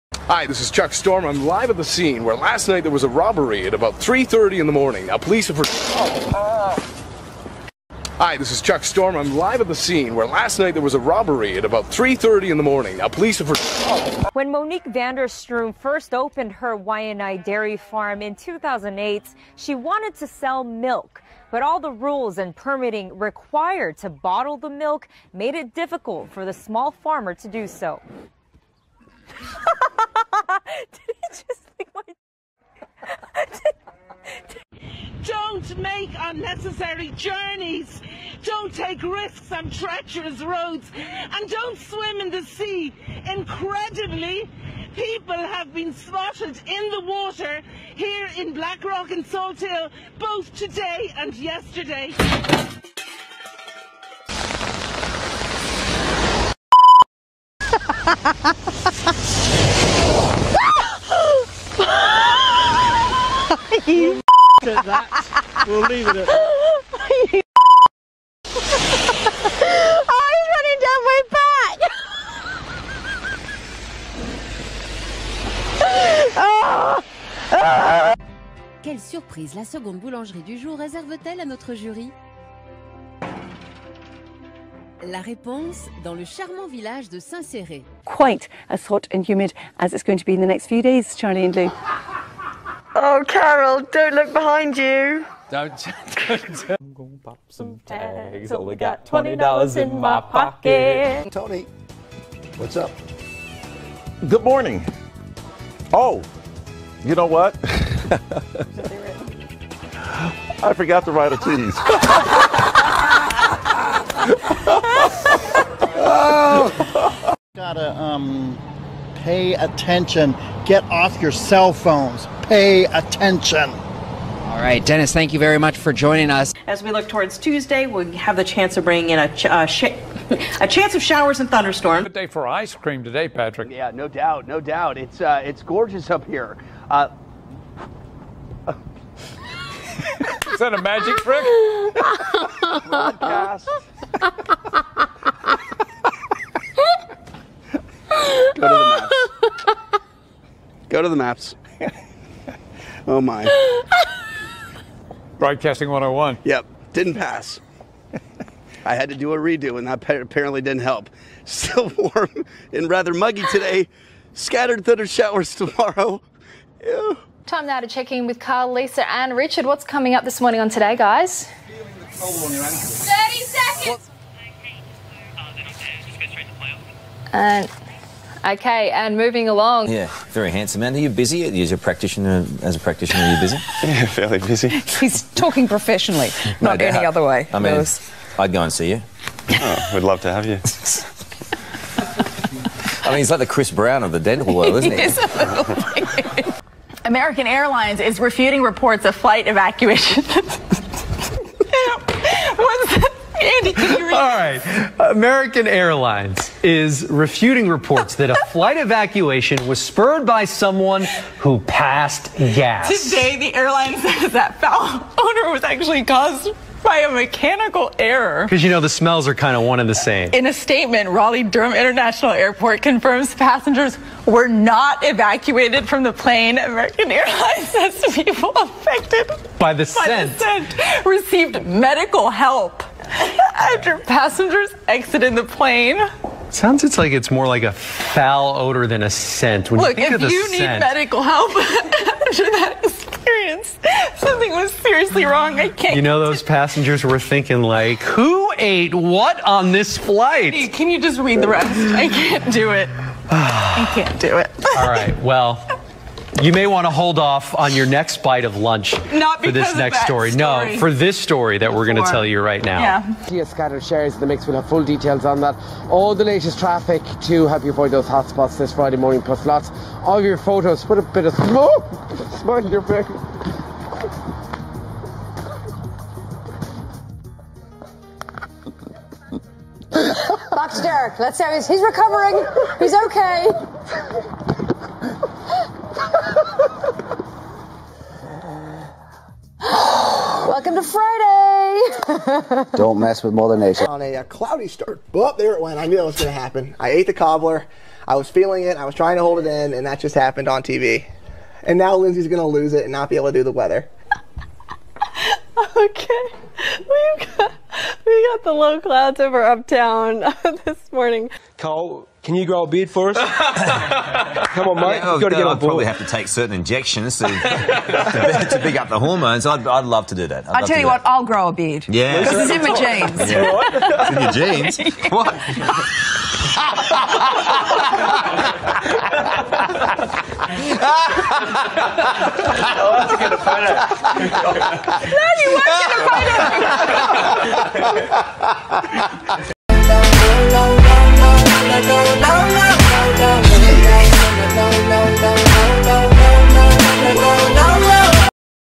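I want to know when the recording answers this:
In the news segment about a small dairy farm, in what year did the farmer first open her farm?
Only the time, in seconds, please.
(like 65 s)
18 s.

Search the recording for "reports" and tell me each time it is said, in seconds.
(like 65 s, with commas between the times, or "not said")
198 s, 207 s.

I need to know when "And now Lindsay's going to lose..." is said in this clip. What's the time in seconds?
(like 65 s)
301 s.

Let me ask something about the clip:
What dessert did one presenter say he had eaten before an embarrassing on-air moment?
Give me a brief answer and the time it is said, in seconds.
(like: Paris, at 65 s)
cobbler, at 297 s.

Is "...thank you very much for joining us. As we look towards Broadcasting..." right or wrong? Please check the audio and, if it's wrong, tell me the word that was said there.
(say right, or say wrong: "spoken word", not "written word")
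wrong: "Tuesday", not "Broadcasting".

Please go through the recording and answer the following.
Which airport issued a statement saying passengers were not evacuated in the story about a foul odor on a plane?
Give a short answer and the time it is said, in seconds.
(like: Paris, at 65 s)
Raleigh Durham International Airport, at 221 s.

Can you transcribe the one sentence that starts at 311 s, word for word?
Cole, can you grow a beard for us?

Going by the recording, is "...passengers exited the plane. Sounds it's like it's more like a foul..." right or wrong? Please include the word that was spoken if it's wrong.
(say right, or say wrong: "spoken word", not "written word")
right.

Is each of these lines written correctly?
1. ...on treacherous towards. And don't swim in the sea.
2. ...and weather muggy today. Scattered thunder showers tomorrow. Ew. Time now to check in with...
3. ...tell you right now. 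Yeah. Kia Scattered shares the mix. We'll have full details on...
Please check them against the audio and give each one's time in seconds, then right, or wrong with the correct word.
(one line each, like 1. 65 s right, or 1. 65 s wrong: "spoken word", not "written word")
1. 39 s wrong: "roads", not "towards"
2. 162 s wrong: "rather", not "weather"
3. 262 s right.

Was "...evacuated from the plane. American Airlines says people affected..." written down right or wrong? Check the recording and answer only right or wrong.
right.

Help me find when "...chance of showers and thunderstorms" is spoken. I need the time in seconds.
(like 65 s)
130 s.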